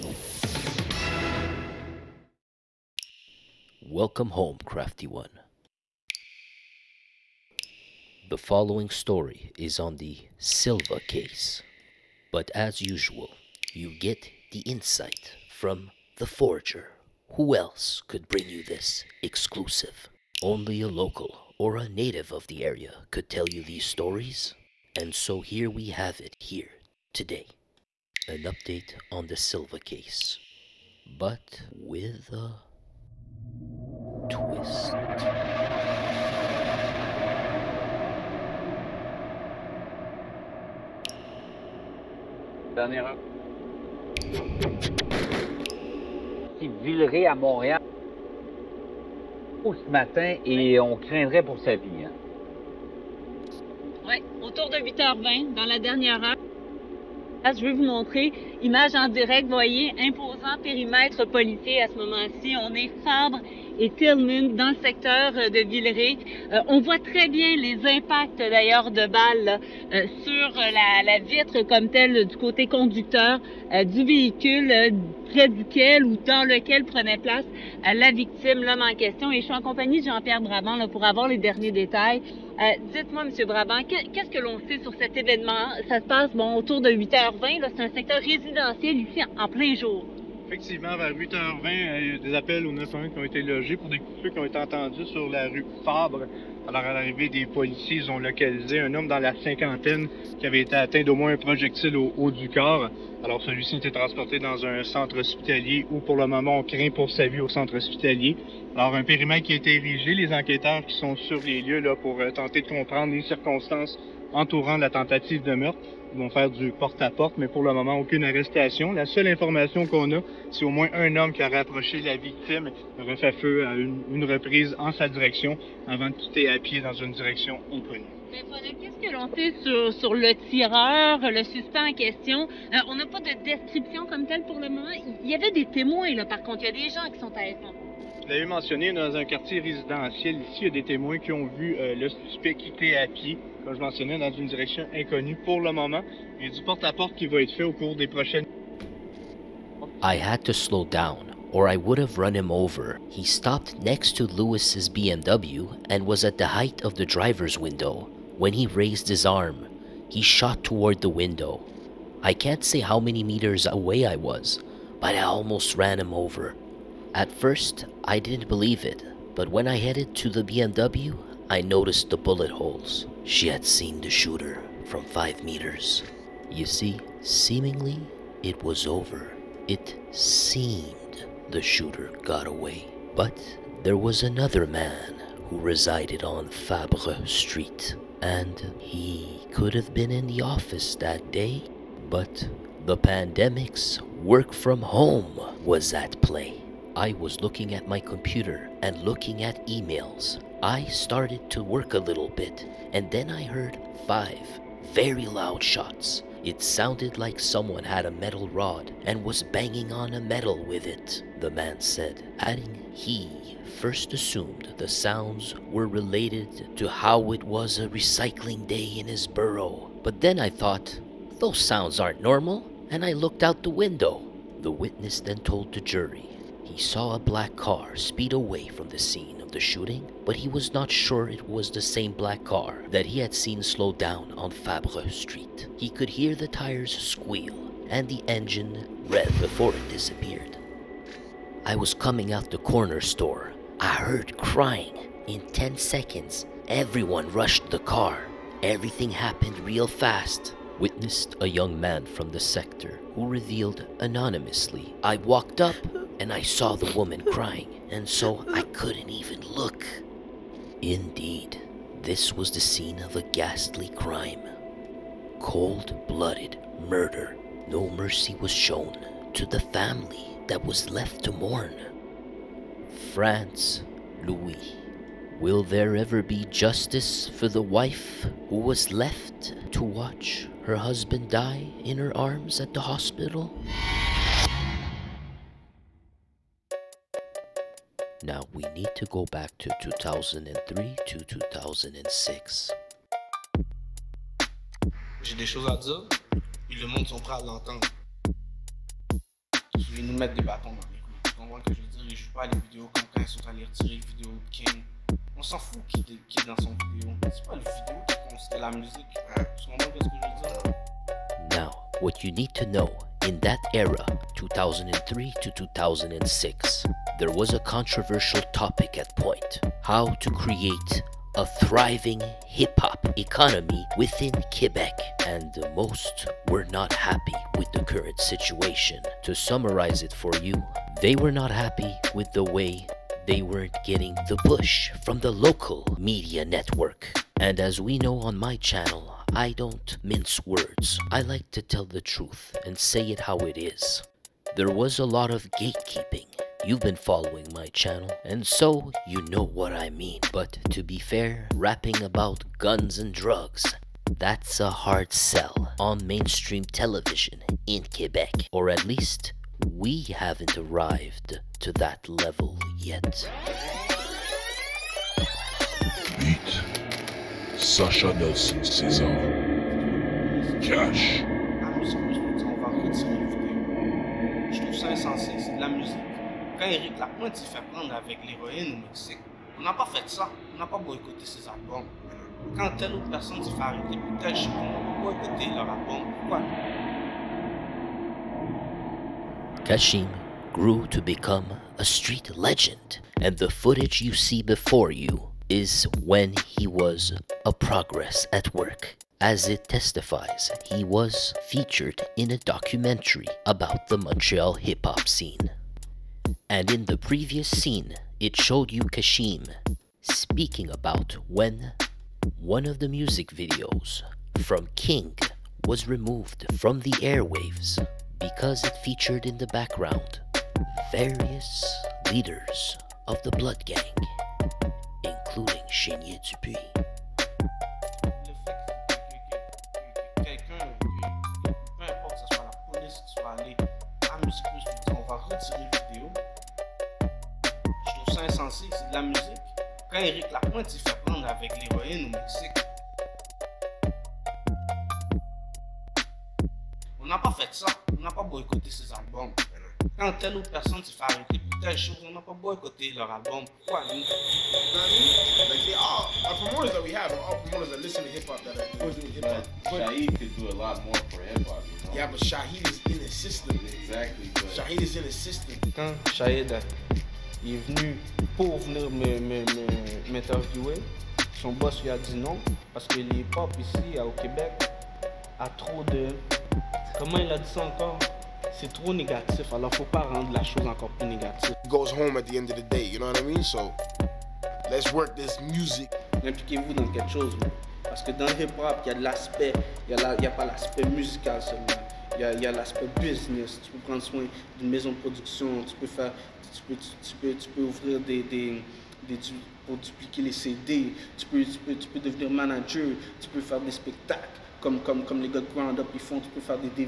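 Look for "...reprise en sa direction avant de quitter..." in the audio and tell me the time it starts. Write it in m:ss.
2:04.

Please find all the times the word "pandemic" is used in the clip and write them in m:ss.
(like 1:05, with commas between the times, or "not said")
3:12.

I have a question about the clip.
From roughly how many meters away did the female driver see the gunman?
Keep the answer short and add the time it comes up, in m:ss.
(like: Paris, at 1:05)
5, at 2:55.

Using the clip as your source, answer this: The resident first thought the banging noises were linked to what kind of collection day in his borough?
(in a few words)
Recycling.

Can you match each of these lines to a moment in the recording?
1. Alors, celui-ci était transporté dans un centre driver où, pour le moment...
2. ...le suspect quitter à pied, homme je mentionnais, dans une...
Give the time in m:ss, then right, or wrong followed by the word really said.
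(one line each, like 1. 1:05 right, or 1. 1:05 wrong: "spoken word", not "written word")
1. 1:43 wrong: "hospitalier", not "driver"
2. 2:21 wrong: "comme", not "homme".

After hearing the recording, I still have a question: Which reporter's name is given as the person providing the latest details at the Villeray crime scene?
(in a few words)
Jean-Pierre Brabant.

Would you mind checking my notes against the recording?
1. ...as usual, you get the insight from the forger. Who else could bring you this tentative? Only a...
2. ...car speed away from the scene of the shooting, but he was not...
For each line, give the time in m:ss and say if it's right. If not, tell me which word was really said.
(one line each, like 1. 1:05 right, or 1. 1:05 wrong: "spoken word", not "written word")
1. 0:12 wrong: "exclusive", not "tentative"
2. 3:47 right.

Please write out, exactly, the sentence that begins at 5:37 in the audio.
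And as we know on my channel, I don't mince words.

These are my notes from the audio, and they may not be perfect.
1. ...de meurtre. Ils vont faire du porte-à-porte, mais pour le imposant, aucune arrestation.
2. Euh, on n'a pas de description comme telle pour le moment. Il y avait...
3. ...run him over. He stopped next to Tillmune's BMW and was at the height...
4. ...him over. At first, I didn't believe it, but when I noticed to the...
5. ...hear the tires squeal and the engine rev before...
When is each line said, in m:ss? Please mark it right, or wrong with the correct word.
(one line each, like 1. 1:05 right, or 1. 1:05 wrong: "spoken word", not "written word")
1. 1:55 wrong: "moment", not "imposant"
2. 2:12 right
3. 2:32 wrong: "Lewis", not "Tillmune"
4. 2:45 wrong: "headed", not "noticed"
5. 3:56 right.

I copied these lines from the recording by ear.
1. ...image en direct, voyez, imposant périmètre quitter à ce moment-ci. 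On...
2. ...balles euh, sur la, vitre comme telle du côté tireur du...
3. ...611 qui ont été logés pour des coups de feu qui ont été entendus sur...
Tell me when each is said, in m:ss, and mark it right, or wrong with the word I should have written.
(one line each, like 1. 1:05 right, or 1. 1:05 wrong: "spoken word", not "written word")
1. 0:58 wrong: "policier", not "quitter"
2. 1:09 wrong: "conducteur", not "tireur"
3. 1:32 wrong: "911", not "611".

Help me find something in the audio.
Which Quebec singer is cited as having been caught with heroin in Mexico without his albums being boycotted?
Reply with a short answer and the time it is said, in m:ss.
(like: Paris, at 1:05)
Eric Lapointe, at 6:16.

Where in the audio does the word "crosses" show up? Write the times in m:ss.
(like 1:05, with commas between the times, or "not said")
not said.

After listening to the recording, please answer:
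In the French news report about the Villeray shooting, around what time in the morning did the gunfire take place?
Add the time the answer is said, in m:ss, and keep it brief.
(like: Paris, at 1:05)
8:20, at 0:54.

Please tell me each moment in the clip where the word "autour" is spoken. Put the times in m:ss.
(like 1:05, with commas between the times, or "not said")
0:54, 1:26.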